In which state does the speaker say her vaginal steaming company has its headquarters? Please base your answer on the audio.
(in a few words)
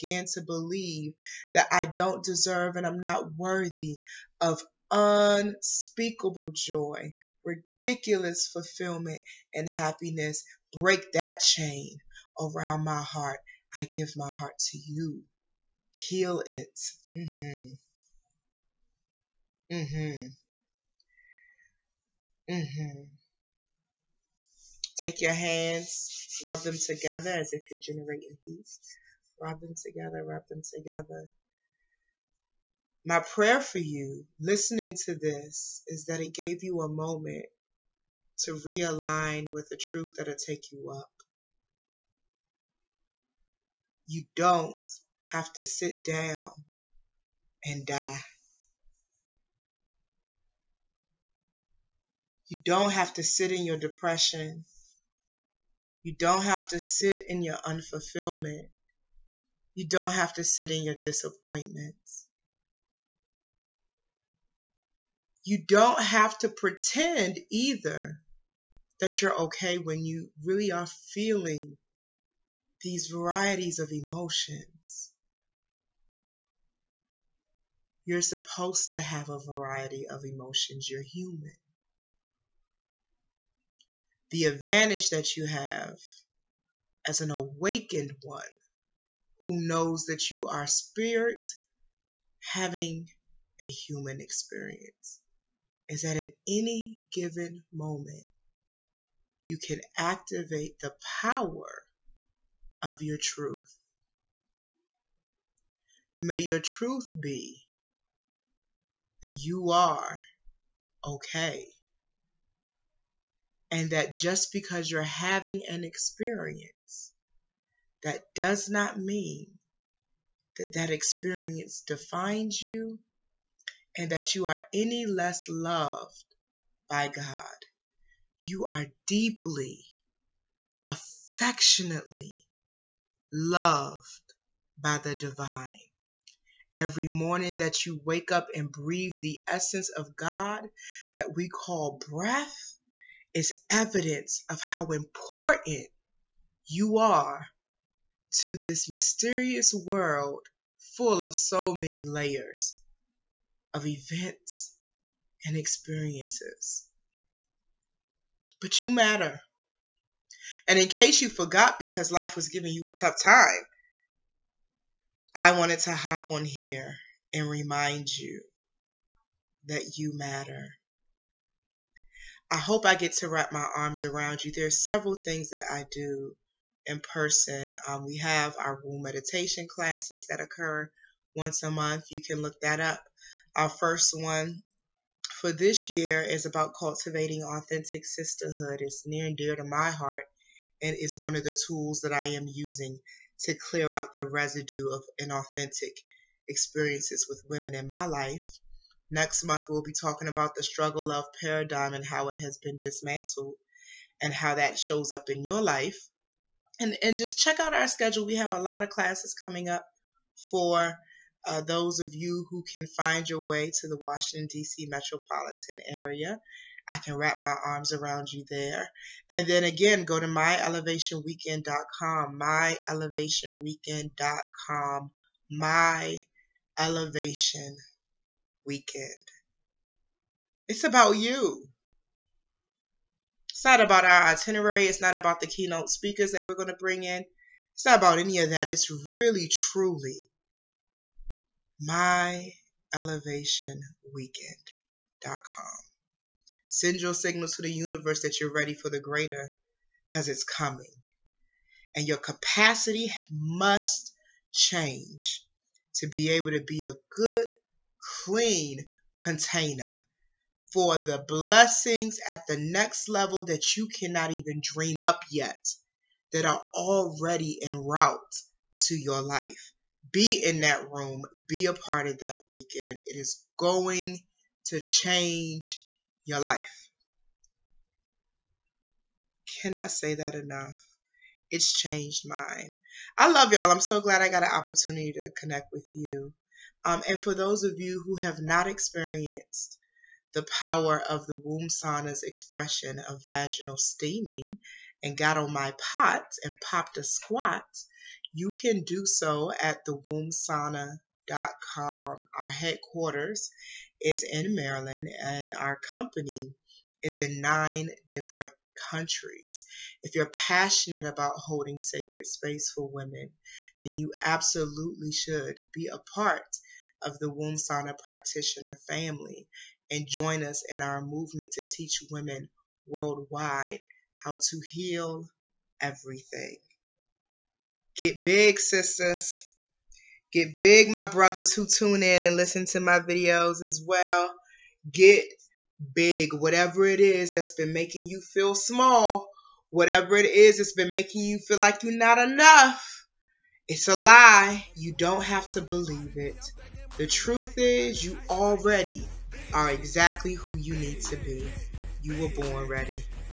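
Maryland.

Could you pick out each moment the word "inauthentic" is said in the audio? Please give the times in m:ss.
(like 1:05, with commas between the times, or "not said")
3:15.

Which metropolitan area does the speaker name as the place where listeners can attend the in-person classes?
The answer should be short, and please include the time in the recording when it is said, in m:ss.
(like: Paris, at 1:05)
Washington, D.C., at 3:33.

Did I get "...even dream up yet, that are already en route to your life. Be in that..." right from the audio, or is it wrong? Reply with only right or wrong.
right.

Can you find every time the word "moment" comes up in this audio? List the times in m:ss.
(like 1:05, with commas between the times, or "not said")
0:36, 1:37.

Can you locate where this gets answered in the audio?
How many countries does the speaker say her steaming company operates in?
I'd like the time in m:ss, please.
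5:07.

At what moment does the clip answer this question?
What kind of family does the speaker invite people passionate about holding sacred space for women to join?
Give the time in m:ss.
5:17.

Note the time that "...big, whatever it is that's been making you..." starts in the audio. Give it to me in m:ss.
5:35.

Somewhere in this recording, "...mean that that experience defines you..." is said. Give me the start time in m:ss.
1:58.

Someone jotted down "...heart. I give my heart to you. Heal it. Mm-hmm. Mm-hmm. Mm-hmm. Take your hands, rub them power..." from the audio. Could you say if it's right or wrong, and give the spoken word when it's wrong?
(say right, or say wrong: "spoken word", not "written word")
wrong: "together", not "power".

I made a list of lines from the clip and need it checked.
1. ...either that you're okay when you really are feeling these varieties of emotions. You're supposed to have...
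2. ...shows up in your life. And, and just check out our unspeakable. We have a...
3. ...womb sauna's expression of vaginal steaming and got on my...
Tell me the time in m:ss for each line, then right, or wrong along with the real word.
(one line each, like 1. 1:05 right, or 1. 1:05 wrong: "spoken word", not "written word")
1. 1:07 right
2. 3:24 wrong: "schedule", not "unspeakable"
3. 4:51 right.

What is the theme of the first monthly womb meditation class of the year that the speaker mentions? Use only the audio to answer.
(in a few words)
Cultivating authentic sisterhood.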